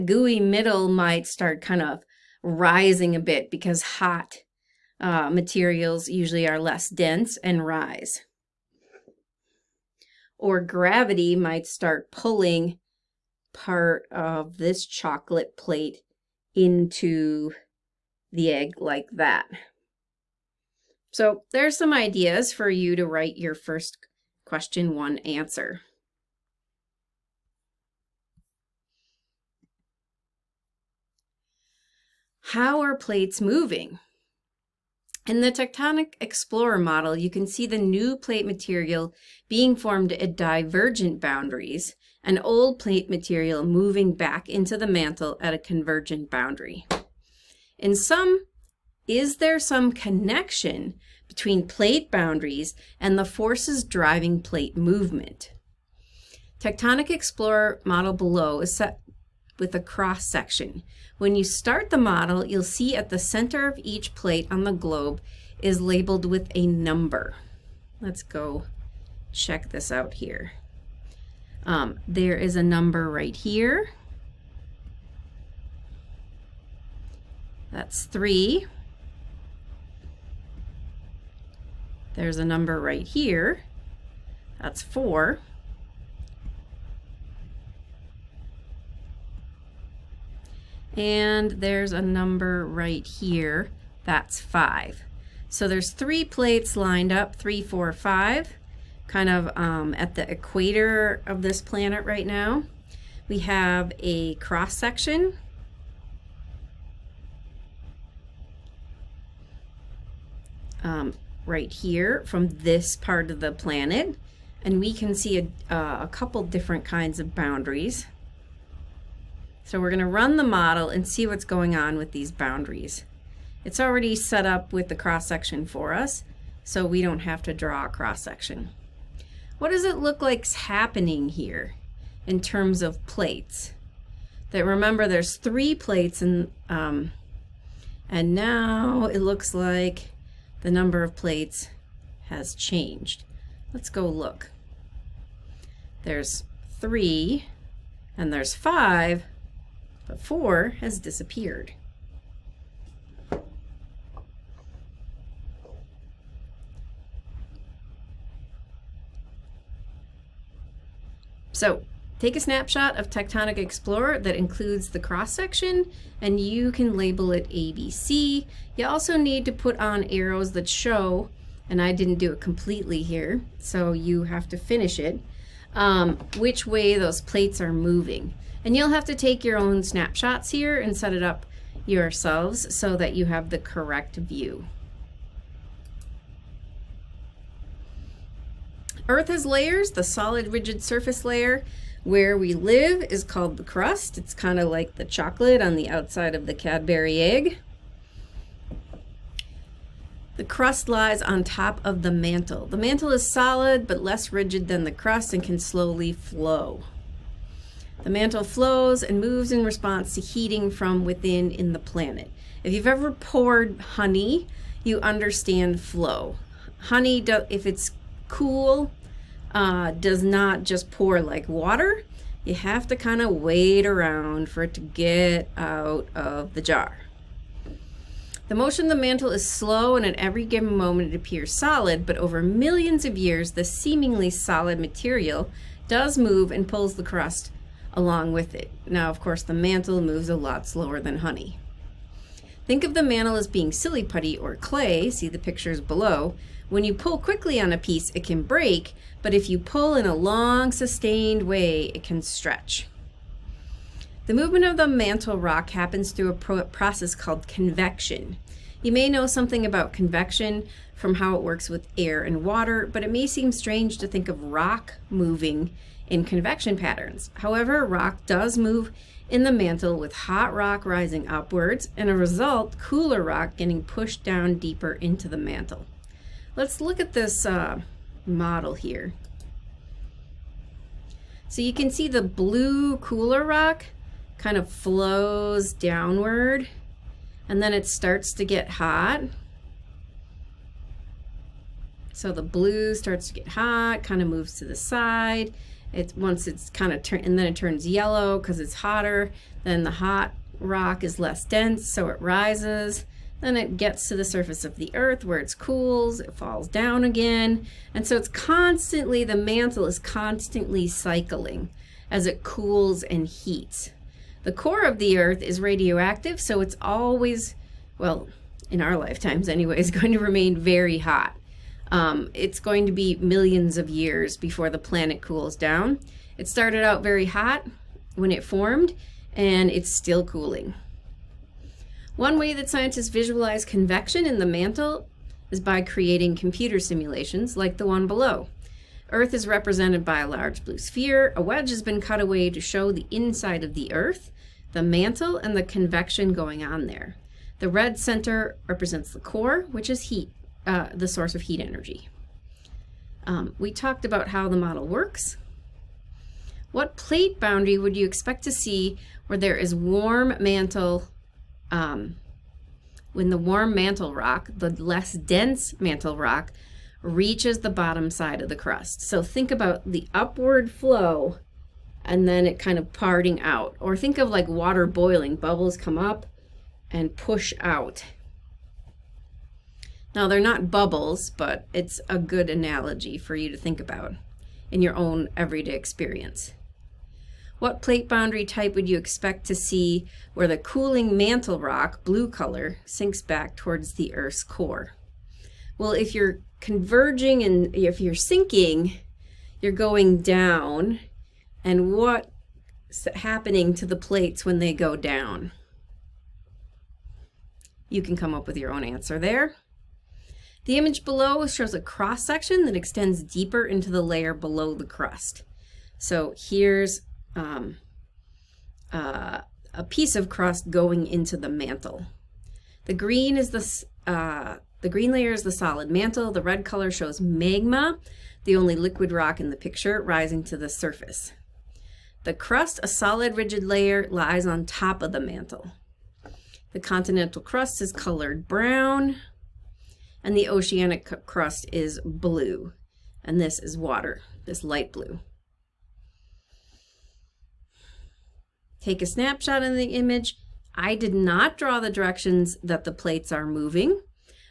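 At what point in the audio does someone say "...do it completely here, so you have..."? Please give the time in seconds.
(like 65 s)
172 s.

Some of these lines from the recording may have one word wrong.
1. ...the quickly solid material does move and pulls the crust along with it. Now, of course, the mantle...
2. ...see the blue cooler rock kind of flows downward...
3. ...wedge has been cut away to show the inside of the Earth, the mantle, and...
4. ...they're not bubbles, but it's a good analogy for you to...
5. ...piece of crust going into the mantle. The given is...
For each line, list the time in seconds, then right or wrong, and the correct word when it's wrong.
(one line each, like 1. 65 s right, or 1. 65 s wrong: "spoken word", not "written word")
1. 233 s wrong: "seemingly", not "quickly"
2. 281 s right
3. 341 s right
4. 380 s right
5. 419 s wrong: "green", not "given".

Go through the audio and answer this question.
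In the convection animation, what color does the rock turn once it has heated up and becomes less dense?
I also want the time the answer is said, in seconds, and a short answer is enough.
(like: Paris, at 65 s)
Yellow, at 297 s.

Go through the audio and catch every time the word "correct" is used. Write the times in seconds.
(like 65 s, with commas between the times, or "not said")
183 s.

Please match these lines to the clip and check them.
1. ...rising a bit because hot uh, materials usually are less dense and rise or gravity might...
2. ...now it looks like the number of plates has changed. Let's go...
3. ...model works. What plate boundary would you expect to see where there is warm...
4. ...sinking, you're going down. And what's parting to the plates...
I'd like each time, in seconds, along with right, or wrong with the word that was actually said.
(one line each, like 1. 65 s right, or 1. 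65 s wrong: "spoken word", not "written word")
1. 2 s right
2. 138 s right
3. 354 s right
4. 398 s wrong: "happening", not "parting".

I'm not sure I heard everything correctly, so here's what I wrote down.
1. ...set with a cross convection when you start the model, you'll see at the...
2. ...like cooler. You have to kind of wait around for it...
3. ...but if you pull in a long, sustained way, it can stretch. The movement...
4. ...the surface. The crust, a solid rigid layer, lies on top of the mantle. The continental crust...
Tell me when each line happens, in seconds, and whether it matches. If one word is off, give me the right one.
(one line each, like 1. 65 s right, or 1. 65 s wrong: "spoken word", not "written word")
1. 58 s wrong: "section", not "convection"
2. 221 s wrong: "water", not "cooler"
3. 249 s right
4. 430 s right.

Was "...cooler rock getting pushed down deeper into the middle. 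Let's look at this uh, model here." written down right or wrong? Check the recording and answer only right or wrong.
wrong.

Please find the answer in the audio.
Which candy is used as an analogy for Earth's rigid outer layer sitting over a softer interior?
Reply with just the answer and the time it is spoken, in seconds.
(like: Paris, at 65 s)
Cadbury egg, at 196 s.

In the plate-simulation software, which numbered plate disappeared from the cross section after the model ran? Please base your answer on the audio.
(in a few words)
4.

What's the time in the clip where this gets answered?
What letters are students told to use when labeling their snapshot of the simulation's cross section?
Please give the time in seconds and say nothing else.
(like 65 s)
167 s.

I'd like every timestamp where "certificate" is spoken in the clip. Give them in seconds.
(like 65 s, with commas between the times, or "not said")
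not said.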